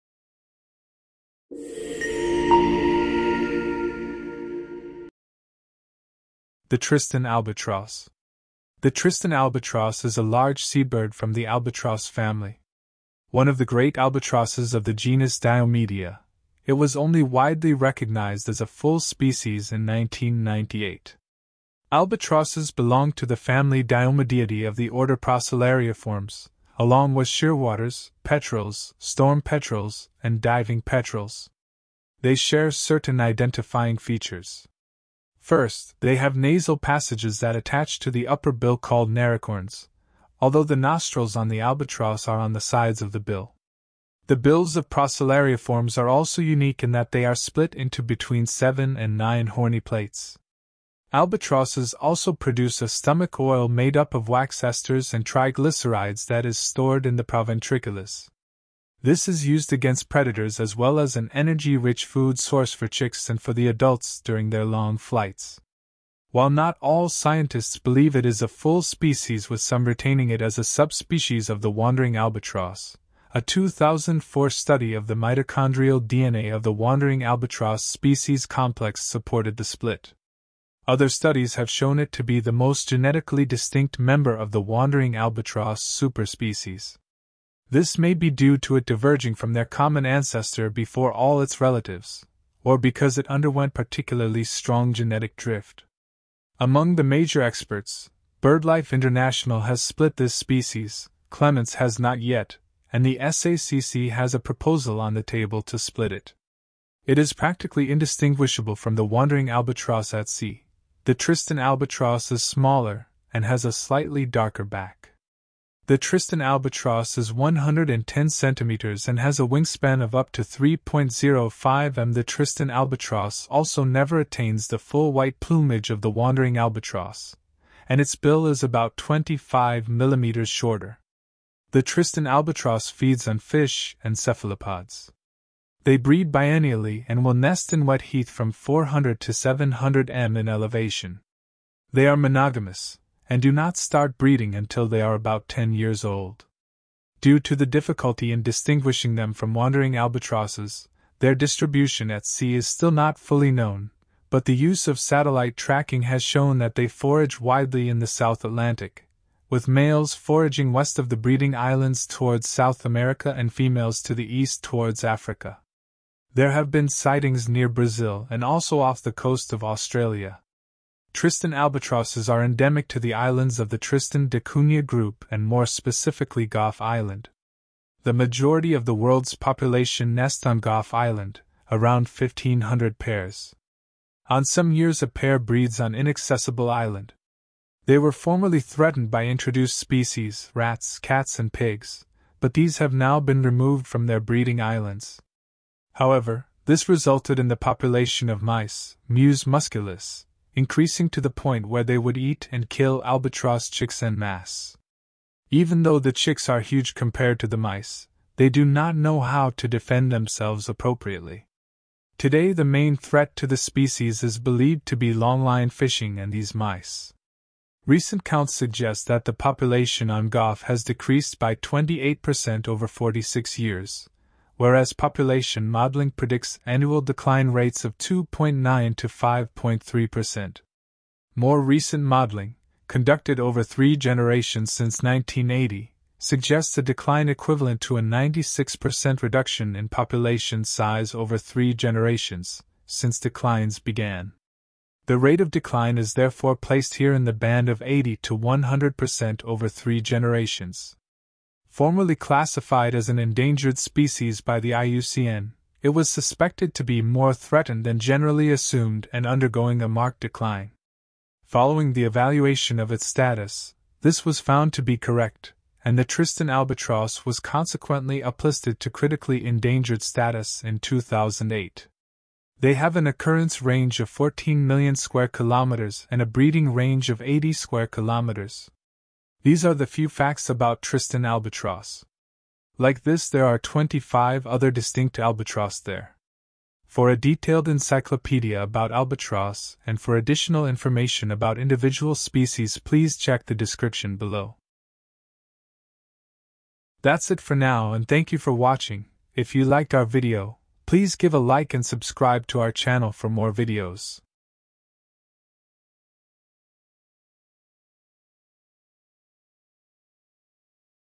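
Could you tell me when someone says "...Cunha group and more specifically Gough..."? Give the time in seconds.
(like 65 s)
174 s.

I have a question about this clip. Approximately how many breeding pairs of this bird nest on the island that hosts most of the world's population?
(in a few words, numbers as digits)
1,500 pairs.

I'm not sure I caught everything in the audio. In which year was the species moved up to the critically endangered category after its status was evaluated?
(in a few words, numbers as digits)
2008.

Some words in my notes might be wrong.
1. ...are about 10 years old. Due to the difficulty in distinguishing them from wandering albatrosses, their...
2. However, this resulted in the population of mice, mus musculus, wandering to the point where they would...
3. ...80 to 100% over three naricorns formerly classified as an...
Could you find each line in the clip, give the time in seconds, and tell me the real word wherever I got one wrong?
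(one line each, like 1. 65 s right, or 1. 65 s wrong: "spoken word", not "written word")
1. 145 s right
2. 195 s wrong: "increasing", not "wandering"
3. 247 s wrong: "generations", not "naricorns".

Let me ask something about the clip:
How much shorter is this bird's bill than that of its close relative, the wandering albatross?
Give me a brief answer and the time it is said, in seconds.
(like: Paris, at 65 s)
25 millimeters, at 128 s.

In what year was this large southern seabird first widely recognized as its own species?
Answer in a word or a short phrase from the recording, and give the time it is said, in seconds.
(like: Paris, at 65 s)
1998, at 19 s.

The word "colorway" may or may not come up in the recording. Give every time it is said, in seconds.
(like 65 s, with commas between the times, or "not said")
not said.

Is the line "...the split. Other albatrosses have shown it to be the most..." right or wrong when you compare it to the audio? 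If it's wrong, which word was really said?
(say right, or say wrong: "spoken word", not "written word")
wrong: "studies", not "albatrosses".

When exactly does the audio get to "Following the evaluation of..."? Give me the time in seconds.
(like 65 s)
261 s.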